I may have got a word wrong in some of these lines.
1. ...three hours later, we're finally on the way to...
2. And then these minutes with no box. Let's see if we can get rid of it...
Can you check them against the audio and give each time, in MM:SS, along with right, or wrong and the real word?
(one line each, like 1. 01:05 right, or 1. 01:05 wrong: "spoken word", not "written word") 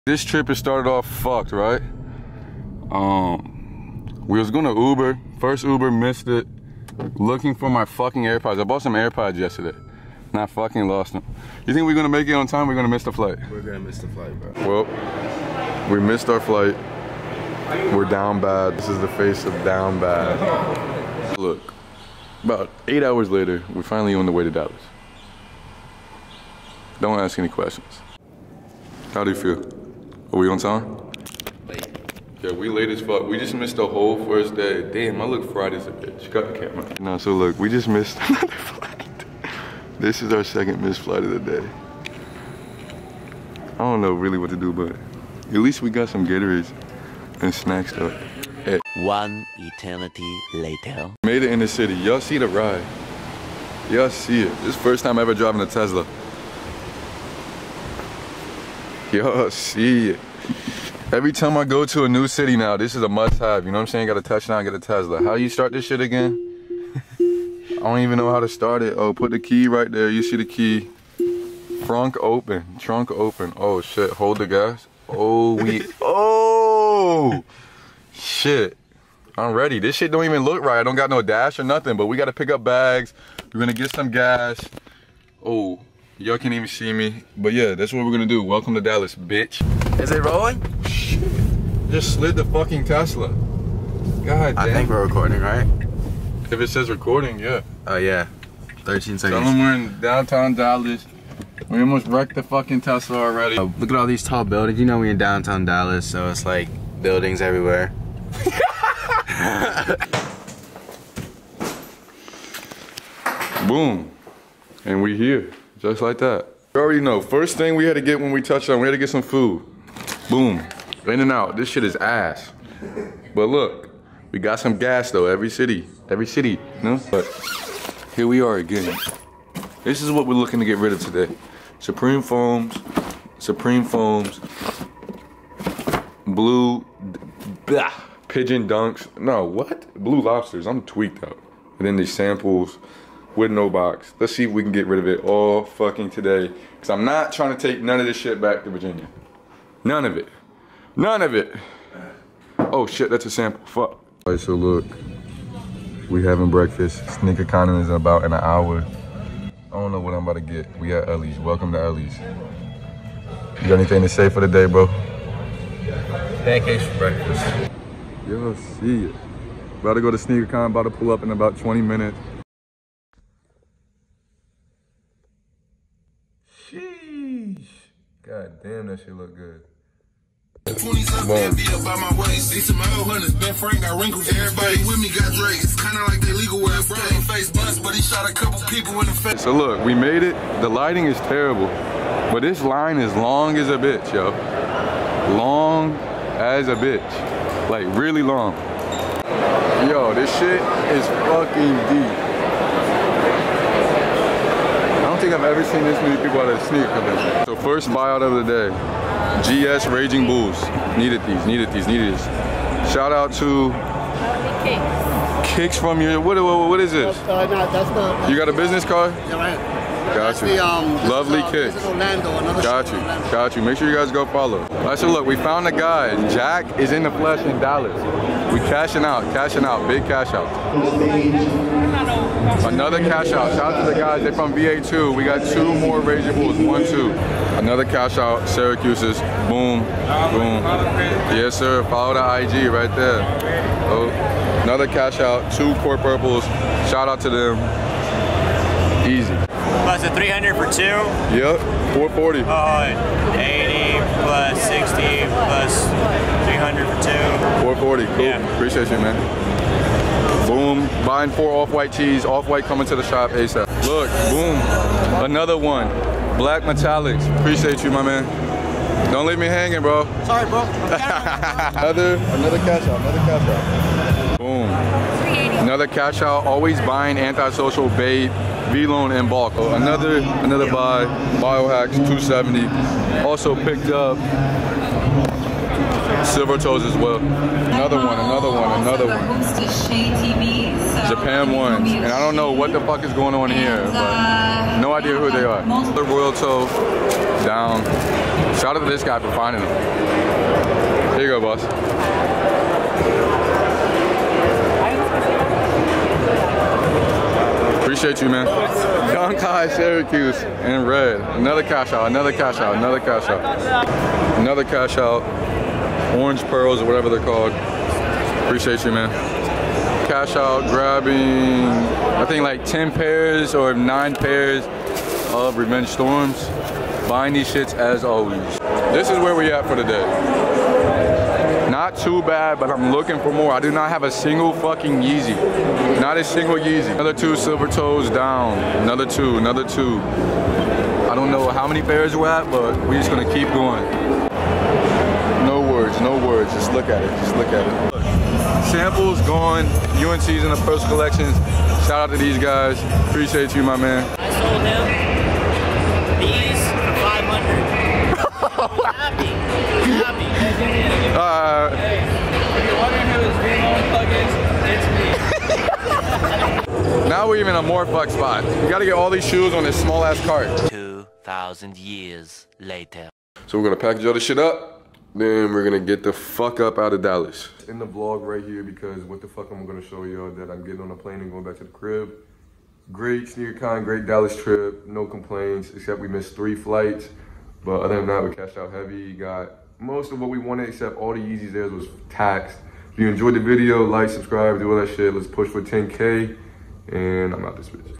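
1. 00:22 wrong: "eight", not "three"
2. 02:21 wrong: "samples", not "minutes".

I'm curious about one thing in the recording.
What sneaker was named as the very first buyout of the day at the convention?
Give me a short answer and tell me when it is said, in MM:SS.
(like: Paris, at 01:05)
GS Raging Bulls, at 03:29.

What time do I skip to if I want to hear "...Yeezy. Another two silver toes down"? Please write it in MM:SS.
05:36.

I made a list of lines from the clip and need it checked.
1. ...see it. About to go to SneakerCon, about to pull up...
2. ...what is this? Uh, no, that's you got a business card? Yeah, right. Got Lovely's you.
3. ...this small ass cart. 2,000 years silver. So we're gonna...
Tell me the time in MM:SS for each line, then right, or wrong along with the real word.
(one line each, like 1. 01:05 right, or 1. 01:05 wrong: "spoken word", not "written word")
1. 02:48 right
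2. 03:36 wrong: "That", not "Lovely"
3. 06:09 wrong: "later", not "silver".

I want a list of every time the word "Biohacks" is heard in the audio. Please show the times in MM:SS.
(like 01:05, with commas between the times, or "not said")
04:41.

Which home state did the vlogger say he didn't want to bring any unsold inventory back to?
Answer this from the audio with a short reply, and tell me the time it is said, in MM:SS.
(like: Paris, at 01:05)
Virginia, at 02:28.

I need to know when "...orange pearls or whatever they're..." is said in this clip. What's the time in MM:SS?
05:16.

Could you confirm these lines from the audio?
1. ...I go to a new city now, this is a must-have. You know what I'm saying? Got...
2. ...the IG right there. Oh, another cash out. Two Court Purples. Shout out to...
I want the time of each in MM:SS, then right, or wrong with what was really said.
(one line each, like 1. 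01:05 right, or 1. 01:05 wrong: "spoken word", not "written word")
1. 01:01 right
2. 04:02 right.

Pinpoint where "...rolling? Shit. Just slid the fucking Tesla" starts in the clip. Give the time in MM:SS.
01:30.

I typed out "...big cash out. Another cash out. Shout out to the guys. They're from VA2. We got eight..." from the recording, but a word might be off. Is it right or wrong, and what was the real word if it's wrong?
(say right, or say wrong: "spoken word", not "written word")
wrong: "two", not "eight".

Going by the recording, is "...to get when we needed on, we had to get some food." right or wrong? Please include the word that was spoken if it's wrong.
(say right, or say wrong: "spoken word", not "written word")
wrong: "touched", not "needed".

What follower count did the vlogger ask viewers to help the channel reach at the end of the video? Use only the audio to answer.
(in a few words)
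10K.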